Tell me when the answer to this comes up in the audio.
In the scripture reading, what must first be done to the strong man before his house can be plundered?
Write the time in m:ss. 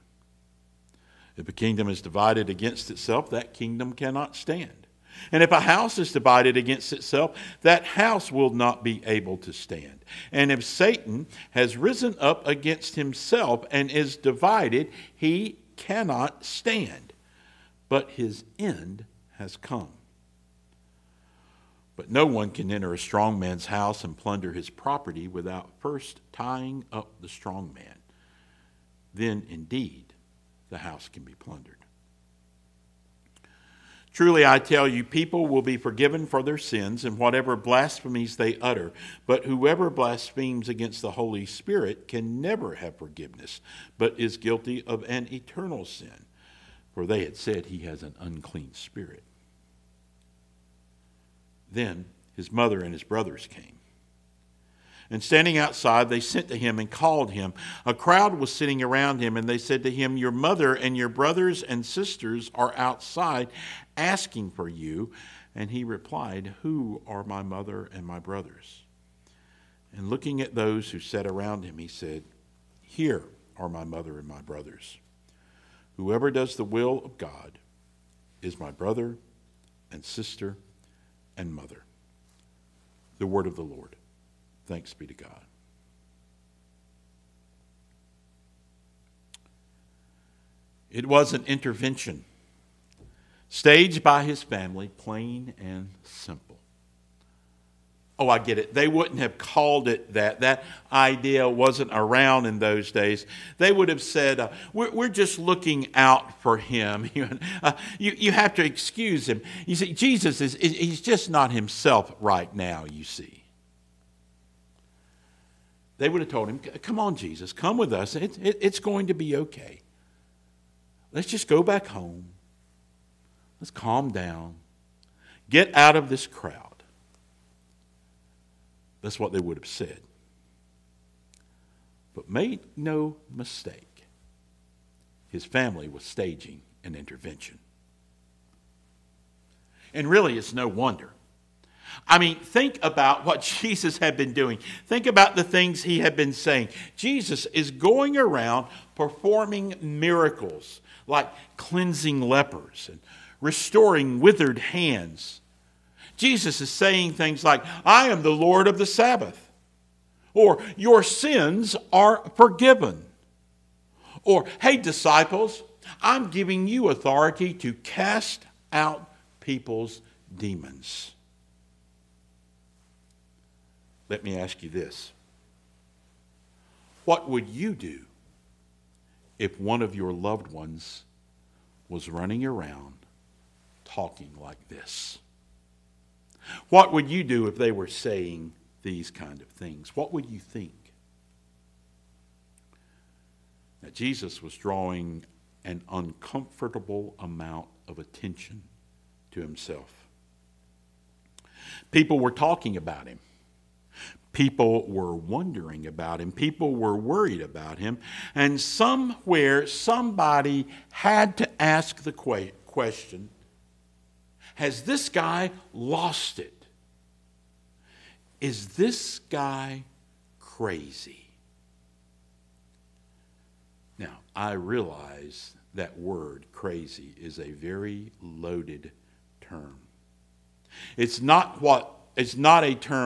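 0:26.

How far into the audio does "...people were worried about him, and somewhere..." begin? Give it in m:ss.
3:26.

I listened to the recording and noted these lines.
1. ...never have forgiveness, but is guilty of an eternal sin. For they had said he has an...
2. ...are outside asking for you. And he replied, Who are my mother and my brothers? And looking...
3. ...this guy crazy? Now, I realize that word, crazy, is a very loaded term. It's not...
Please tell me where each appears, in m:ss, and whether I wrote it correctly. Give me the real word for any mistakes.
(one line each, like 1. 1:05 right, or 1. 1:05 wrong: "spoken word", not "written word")
1. 0:42 right
2. 1:02 right
3. 3:38 right.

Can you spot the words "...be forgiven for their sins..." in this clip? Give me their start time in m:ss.
0:35.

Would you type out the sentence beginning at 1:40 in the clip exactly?
That idea wasn't around in those days.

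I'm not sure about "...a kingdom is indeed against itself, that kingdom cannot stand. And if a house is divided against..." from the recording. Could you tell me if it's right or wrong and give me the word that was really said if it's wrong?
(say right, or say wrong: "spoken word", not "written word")
wrong: "divided", not "indeed".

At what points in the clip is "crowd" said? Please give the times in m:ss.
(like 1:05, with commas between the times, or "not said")
0:57, 2:06.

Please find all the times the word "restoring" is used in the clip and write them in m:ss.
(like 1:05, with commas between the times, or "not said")
2:33.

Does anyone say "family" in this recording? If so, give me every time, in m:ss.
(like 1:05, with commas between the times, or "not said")
1:34, 2:15.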